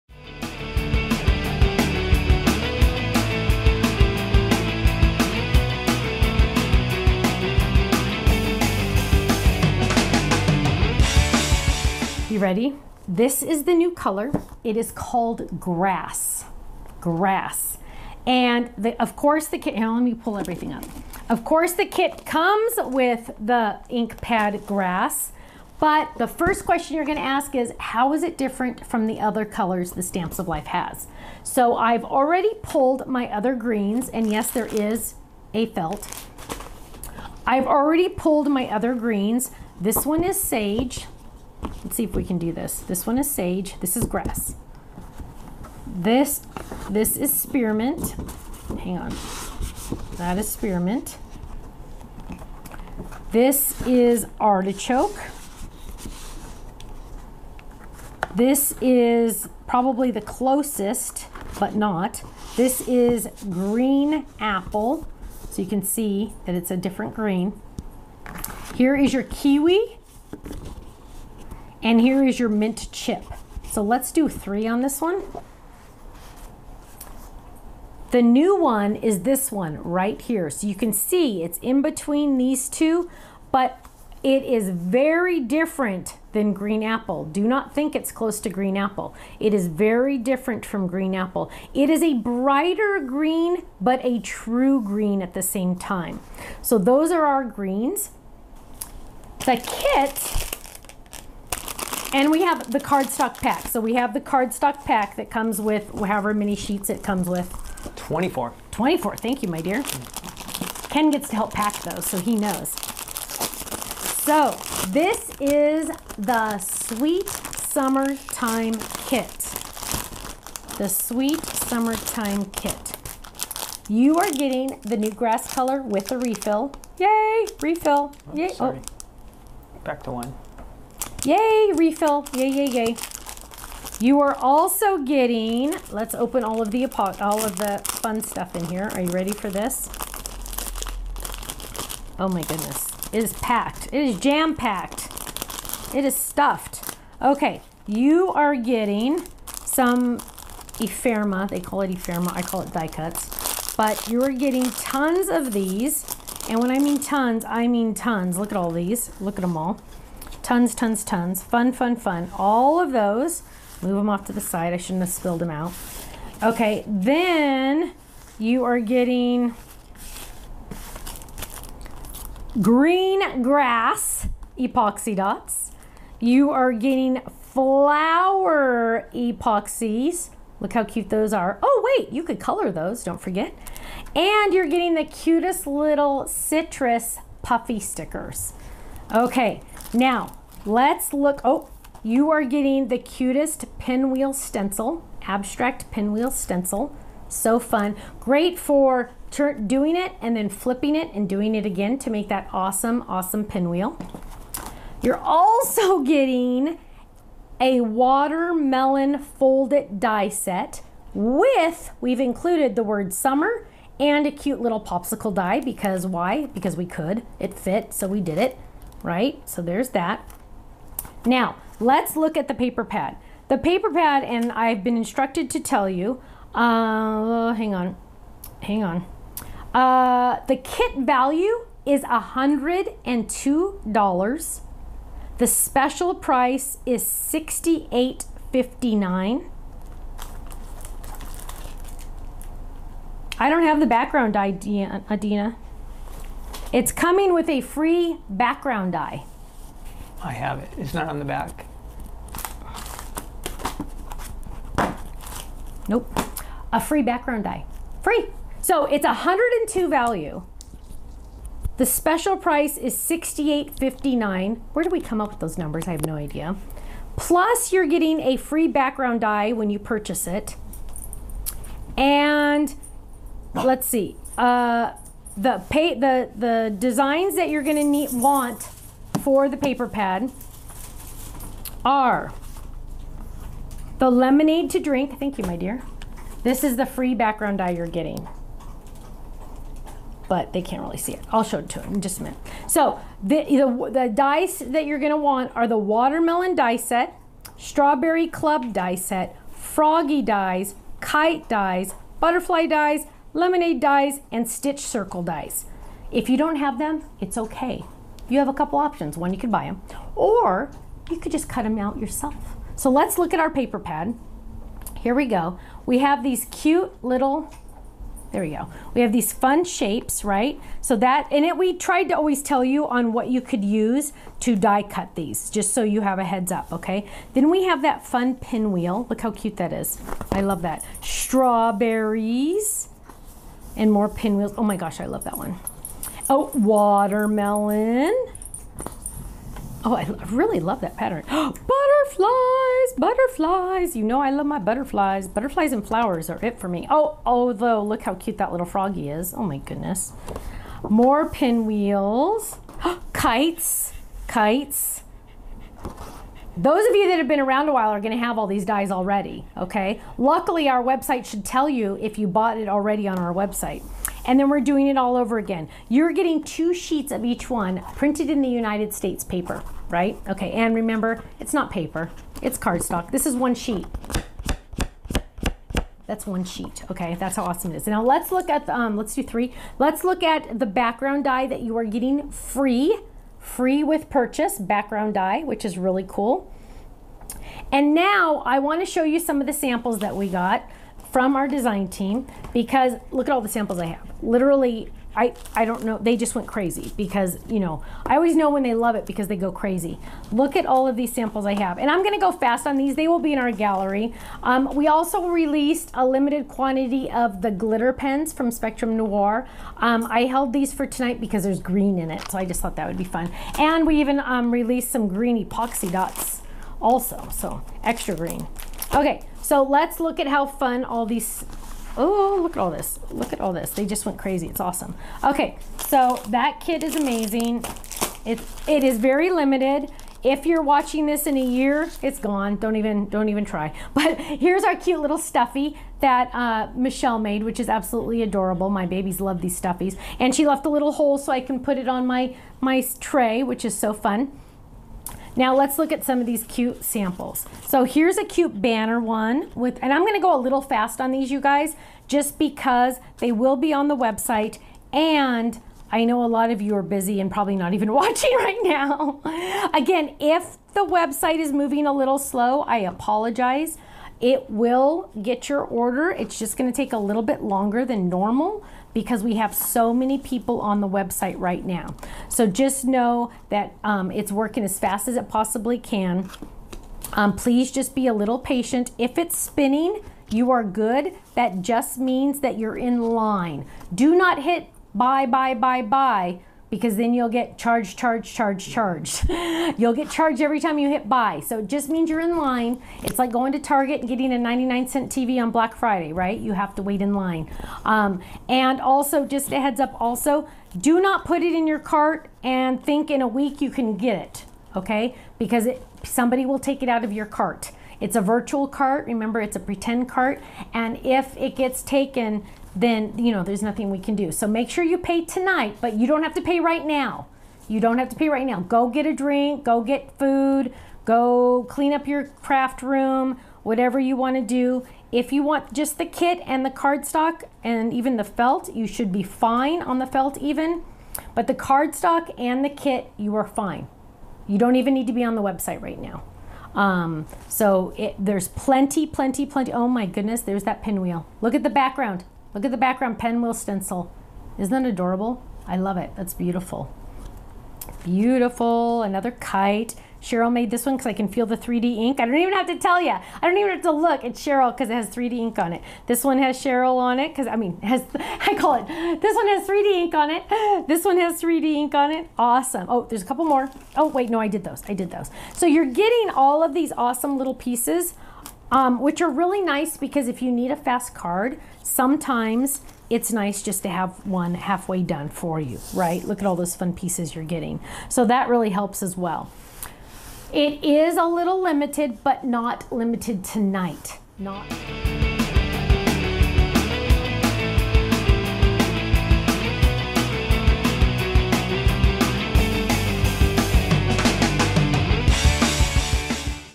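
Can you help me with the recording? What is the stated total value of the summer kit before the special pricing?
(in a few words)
$102.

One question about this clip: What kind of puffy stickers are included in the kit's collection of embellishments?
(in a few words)
Citrus.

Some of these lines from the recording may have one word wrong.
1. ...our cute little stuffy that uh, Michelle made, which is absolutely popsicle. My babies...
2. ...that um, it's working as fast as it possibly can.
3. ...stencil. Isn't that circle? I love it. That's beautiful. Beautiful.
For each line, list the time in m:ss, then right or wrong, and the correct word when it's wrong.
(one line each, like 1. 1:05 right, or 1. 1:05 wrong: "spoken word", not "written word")
1. 7:14 wrong: "adorable", not "popsicle"
2. 7:53 right
3. 9:03 wrong: "adorable", not "circle".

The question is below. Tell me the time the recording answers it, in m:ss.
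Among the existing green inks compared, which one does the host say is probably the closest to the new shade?
0:53.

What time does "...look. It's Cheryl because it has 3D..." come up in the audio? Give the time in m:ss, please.
9:13.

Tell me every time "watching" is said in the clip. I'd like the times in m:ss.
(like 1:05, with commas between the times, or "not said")
7:10, 7:37.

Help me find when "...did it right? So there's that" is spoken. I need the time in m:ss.
3:38.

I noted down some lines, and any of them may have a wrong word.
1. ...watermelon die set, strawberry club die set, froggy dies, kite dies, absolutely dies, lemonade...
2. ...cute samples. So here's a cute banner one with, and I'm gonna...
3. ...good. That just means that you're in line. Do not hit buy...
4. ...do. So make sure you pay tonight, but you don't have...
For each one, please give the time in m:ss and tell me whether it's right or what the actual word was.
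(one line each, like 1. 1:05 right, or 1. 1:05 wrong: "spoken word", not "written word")
1. 4:55 wrong: "butterfly", not "absolutely"
2. 7:26 right
3. 8:00 right
4. 8:34 right.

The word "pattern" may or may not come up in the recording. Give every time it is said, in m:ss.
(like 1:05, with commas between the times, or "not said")
5:40.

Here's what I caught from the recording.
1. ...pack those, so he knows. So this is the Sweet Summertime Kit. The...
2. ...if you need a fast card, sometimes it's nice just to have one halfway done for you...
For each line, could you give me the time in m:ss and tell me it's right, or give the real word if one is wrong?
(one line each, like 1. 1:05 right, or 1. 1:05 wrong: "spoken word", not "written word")
1. 1:51 right
2. 9:30 right.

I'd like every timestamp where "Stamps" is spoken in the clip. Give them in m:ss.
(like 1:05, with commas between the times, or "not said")
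0:30.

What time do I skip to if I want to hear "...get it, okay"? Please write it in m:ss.
8:23.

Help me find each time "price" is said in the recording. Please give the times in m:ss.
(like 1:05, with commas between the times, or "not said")
3:56, 4:22.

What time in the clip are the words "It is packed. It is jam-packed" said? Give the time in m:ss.
2:23.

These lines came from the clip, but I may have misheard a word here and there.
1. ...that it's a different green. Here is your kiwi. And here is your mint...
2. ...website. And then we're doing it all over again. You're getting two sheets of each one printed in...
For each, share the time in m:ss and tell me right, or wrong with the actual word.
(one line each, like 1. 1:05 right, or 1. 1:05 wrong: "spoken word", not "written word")
1. 1:06 right
2. 6:03 right.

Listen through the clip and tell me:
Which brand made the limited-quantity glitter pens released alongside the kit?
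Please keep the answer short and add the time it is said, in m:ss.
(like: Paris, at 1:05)
Spectrum Noir, at 6:48.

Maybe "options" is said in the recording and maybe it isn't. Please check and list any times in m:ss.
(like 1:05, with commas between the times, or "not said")
5:08.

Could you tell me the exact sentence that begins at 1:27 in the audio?
Do not think it's close to green apple.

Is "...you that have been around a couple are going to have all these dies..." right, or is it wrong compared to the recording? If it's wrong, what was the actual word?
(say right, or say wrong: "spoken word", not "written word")
wrong: "while", not "couple".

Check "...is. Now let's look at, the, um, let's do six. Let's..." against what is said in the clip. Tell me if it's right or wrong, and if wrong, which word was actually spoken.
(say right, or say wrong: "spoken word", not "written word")
wrong: "three", not "six".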